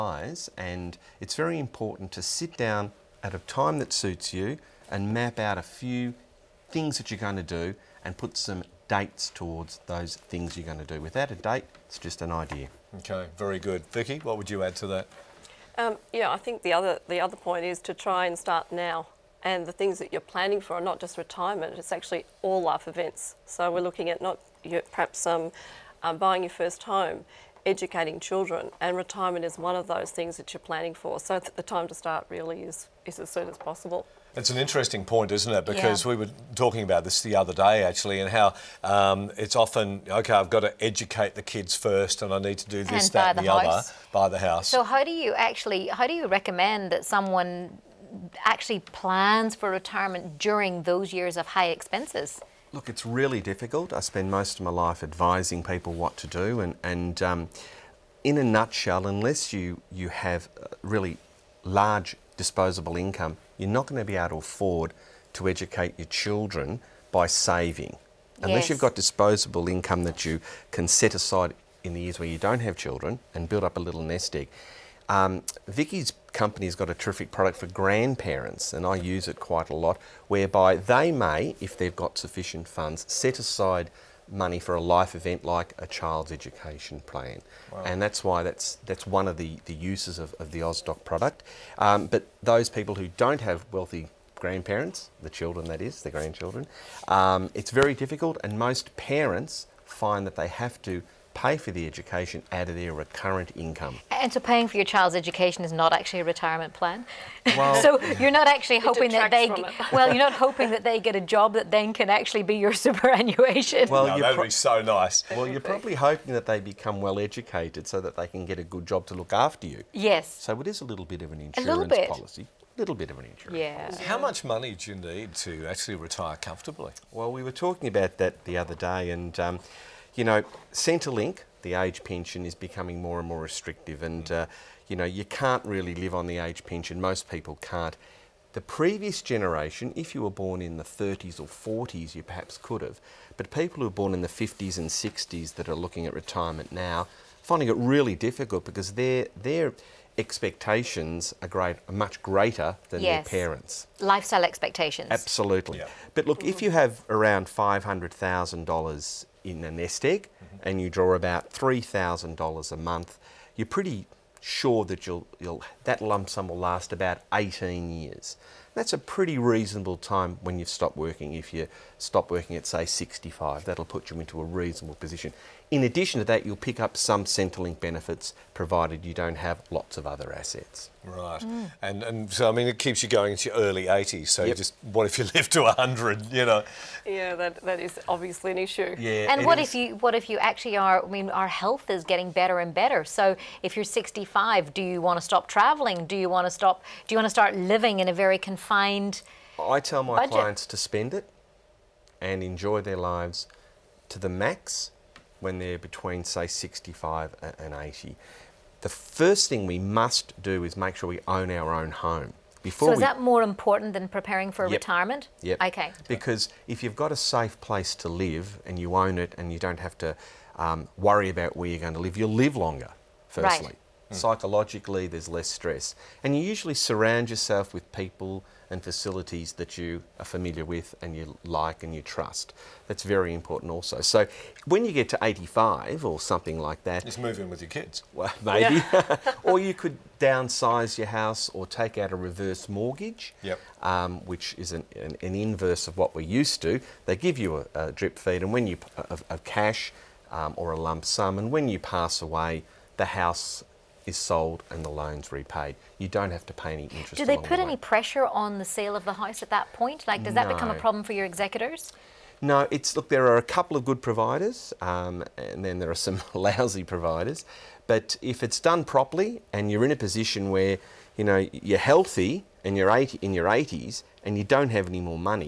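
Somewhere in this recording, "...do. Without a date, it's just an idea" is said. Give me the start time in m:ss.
0:10.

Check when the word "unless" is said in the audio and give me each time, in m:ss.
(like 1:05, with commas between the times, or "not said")
0:59, 1:08.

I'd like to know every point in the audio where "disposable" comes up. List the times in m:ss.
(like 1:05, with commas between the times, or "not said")
1:02, 1:08.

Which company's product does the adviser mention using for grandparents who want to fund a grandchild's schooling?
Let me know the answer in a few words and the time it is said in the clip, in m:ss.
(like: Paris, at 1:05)
Austock, at 1:30.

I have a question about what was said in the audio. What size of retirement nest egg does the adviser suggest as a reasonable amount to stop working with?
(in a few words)
$500,000.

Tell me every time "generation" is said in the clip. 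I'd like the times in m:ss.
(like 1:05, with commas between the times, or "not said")
2:19.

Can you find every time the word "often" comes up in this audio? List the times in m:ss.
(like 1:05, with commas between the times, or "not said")
0:39.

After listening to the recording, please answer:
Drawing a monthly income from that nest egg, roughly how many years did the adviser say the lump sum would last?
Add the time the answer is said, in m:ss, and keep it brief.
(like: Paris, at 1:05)
18 years, at 2:47.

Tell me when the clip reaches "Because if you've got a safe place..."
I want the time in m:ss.
3:36.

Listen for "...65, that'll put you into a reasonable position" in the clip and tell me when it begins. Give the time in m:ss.
2:52.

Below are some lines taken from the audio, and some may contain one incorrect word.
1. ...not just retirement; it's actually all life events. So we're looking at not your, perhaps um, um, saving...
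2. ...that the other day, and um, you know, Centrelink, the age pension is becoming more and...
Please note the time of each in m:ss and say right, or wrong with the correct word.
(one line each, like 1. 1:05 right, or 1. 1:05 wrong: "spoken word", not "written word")
1. 0:20 wrong: "buying", not "saving"
2. 2:08 right.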